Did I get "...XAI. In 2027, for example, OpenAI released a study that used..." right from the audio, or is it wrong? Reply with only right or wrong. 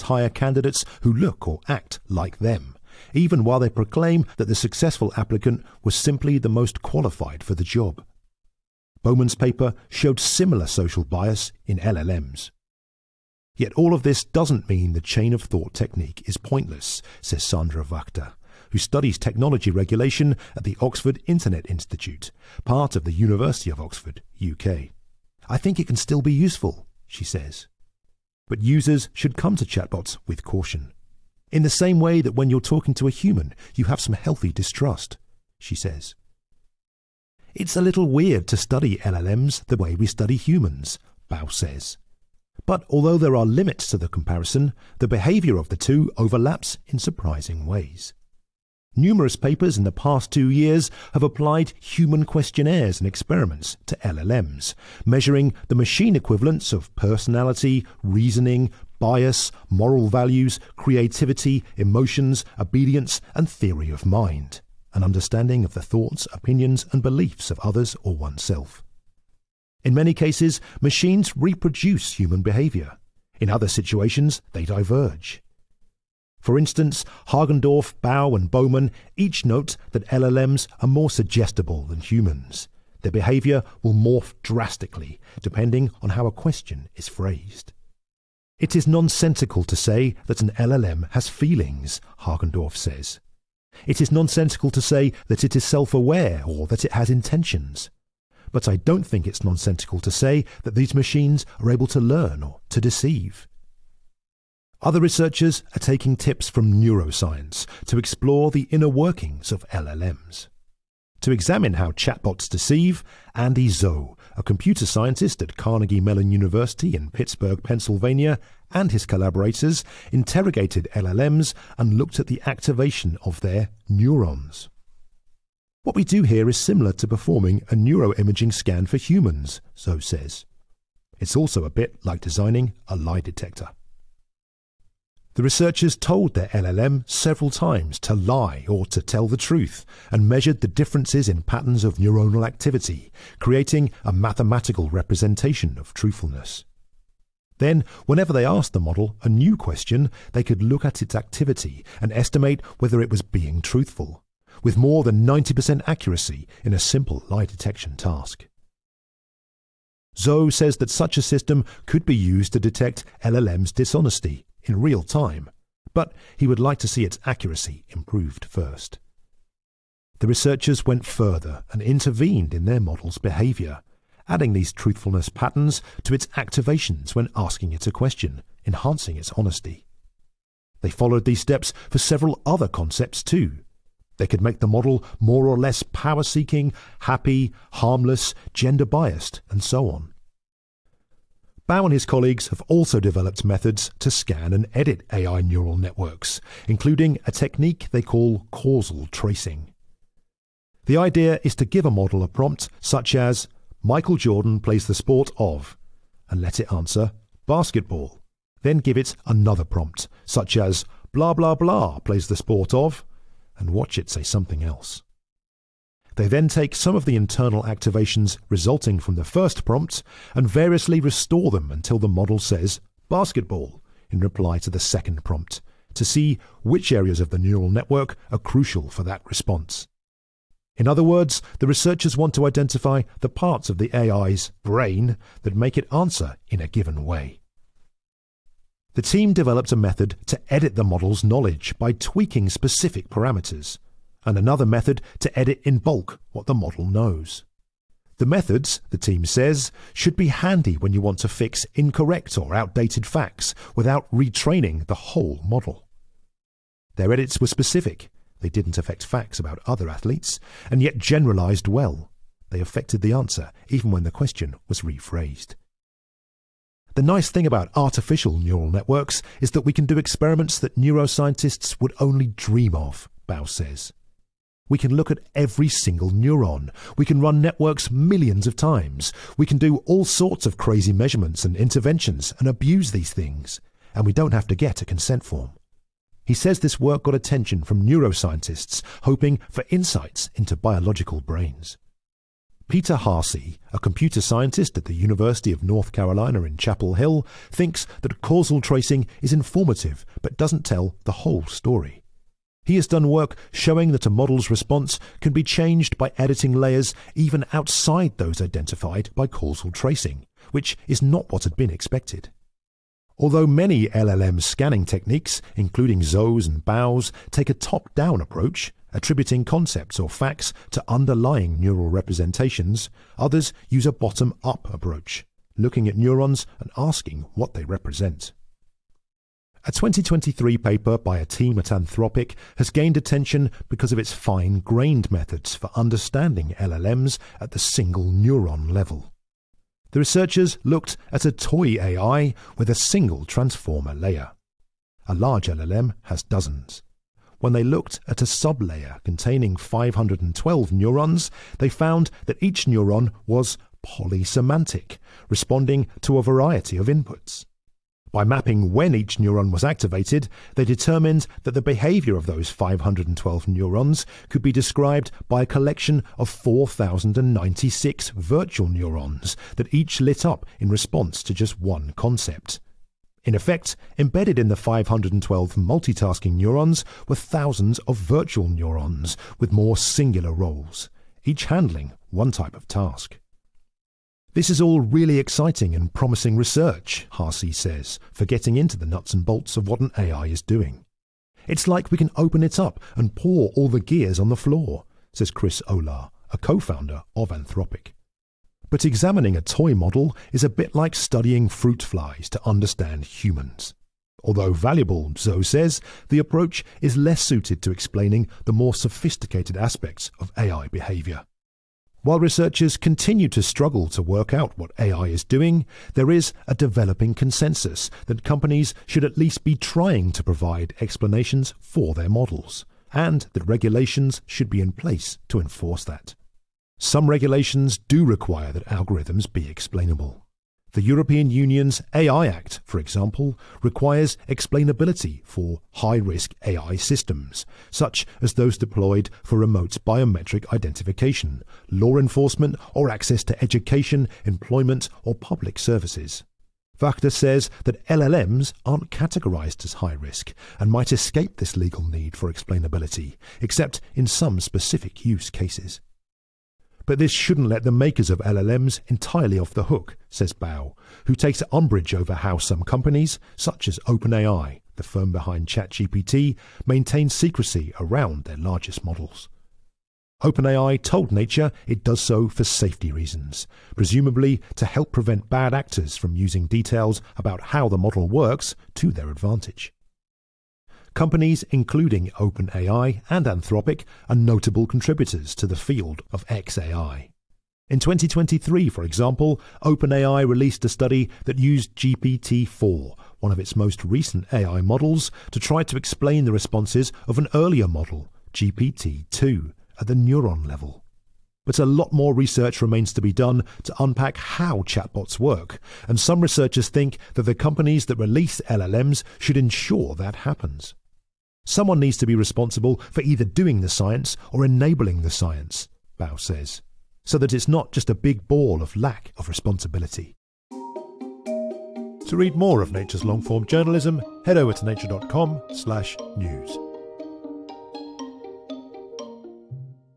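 wrong.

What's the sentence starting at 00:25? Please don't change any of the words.
I think it can still be useful, she says.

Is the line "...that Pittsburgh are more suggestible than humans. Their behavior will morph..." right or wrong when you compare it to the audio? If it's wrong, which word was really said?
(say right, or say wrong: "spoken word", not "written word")
wrong: "LLMs", not "Pittsburgh".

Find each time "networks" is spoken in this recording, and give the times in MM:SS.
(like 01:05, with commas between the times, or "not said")
03:15, 03:47, 04:28, 04:37.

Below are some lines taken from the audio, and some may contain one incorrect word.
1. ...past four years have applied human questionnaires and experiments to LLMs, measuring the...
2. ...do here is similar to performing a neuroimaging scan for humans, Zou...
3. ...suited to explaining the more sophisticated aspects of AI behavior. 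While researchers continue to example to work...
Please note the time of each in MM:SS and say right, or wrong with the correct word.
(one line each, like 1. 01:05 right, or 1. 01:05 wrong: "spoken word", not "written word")
1. 00:49 wrong: "two", not "four"
2. 02:06 right
3. 06:47 wrong: "struggle", not "example".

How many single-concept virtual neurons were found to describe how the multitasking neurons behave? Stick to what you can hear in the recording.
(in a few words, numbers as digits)
4,096.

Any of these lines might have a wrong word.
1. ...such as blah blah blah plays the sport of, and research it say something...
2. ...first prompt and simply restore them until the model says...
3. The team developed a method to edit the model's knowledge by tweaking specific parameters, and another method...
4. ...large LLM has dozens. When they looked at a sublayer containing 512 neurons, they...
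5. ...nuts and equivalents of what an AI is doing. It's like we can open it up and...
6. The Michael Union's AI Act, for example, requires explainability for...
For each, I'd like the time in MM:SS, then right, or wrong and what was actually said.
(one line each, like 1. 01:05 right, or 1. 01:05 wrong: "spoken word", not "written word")
1. 03:30 wrong: "watch", not "research"
2. 03:39 wrong: "variously", not "simply"
3. 03:58 right
4. 05:45 right
5. 06:28 wrong: "bolts", not "equivalents"
6. 07:10 wrong: "European", not "Michael".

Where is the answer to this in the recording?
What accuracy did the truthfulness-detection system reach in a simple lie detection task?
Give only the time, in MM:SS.
02:34.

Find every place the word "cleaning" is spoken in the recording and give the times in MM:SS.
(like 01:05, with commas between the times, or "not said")
not said.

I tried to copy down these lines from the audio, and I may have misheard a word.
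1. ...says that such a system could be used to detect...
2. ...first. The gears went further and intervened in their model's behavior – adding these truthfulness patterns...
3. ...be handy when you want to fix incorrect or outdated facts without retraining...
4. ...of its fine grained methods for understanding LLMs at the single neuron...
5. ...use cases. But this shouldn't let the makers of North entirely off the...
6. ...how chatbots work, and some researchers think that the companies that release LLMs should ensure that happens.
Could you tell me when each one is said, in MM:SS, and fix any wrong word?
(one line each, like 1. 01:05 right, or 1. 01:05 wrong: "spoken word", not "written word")
1. 02:40 right
2. 02:48 wrong: "researchers", not "gears"
3. 04:10 right
4. 05:33 right
5. 07:35 wrong: "LLMs", not "North"
6. 08:24 right.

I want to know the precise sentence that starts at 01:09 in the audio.
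In many cases, machines reproduce human behavior.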